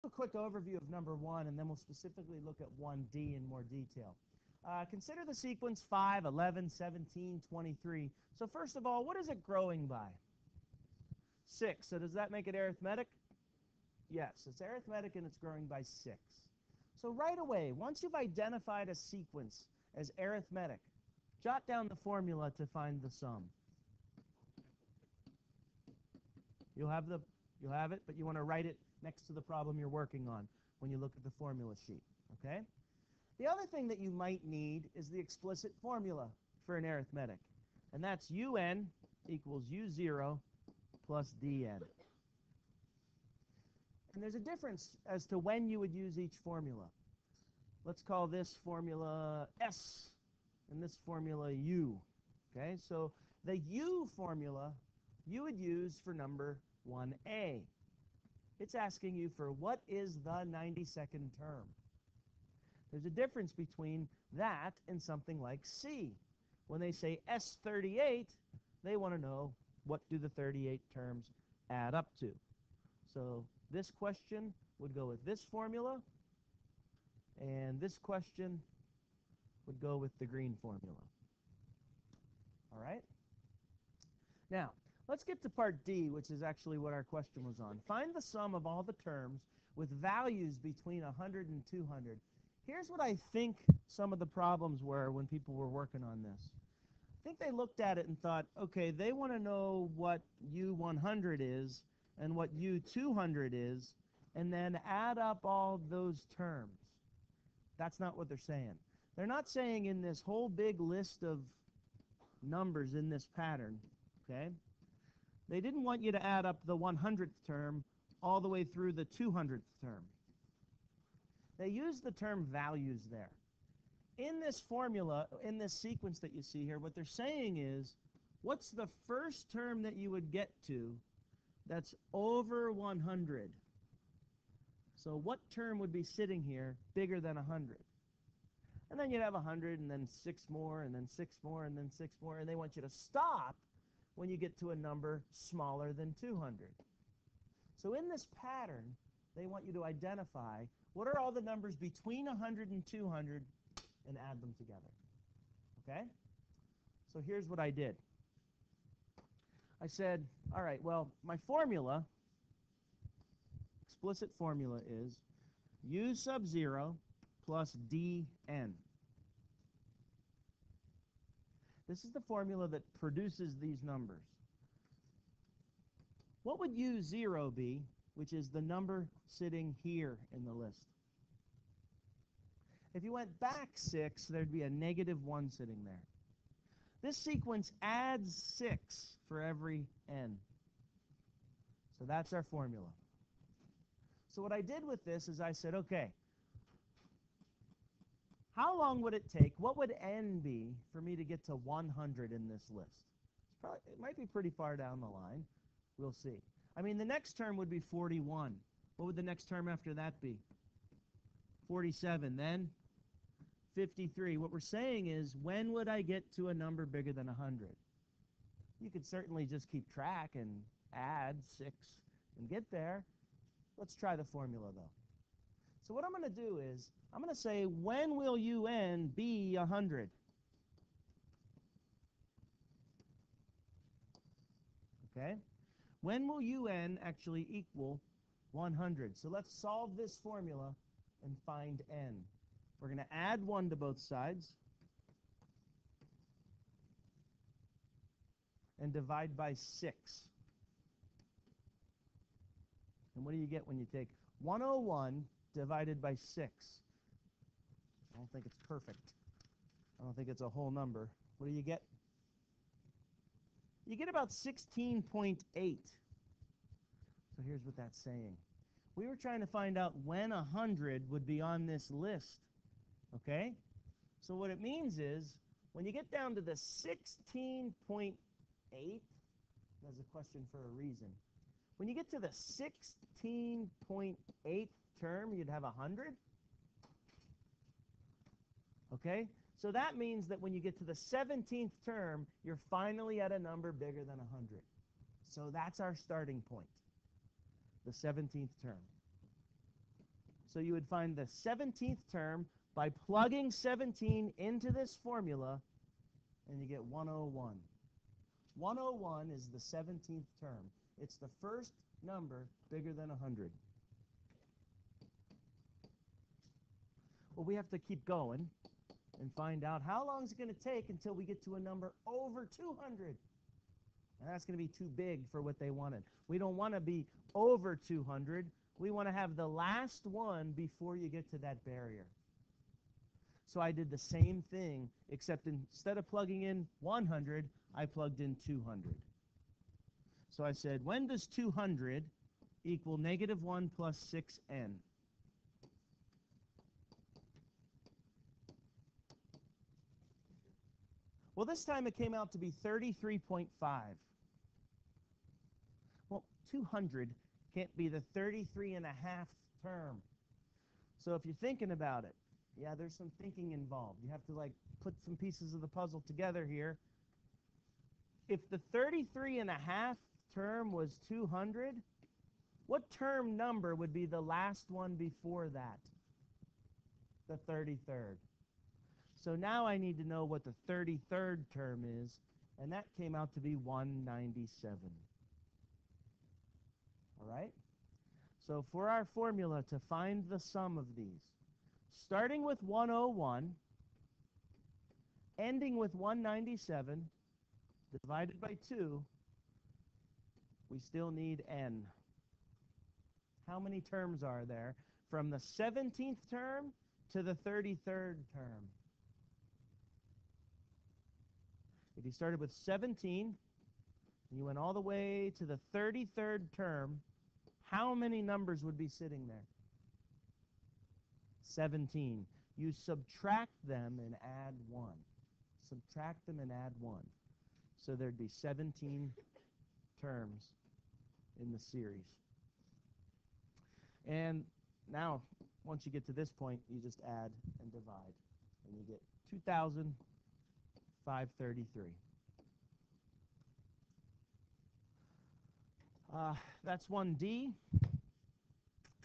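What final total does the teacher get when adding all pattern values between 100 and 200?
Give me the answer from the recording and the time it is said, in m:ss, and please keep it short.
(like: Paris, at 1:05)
2533, at 7:19.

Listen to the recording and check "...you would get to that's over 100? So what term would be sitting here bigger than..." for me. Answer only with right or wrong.
right.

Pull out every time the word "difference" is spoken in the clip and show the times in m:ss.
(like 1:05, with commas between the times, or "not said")
0:44, 1:03.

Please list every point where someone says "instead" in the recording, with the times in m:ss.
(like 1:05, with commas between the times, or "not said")
5:35.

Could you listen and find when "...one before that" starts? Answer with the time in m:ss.
6:14.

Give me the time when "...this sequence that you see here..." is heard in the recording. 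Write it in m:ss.
2:05.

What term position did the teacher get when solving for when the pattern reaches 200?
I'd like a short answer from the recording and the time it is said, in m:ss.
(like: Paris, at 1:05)
33.5, at 5:52.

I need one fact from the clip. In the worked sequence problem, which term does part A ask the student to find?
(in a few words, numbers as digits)
92nd.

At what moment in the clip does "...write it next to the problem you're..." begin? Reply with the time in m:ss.
0:28.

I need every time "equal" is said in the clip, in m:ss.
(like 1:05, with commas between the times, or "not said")
0:39, 3:57, 5:42.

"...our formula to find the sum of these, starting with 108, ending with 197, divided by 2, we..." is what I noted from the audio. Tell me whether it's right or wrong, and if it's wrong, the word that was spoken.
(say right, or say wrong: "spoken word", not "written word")
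wrong: "101", not "108".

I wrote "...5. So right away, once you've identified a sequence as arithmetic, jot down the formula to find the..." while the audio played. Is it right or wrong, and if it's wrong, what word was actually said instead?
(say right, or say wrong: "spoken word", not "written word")
wrong: "6", not "5".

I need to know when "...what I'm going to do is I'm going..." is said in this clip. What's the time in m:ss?
3:45.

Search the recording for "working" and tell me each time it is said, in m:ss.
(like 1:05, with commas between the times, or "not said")
0:29, 1:35.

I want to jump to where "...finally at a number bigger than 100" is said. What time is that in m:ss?
4:52.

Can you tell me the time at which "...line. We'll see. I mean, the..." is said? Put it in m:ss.
3:25.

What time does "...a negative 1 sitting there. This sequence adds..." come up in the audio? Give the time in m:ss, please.
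3:04.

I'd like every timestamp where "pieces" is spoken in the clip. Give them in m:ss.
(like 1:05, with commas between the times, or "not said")
6:05.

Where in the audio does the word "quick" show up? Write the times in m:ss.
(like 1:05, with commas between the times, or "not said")
0:00.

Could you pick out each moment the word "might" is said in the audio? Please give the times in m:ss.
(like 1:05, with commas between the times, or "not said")
0:34, 3:23.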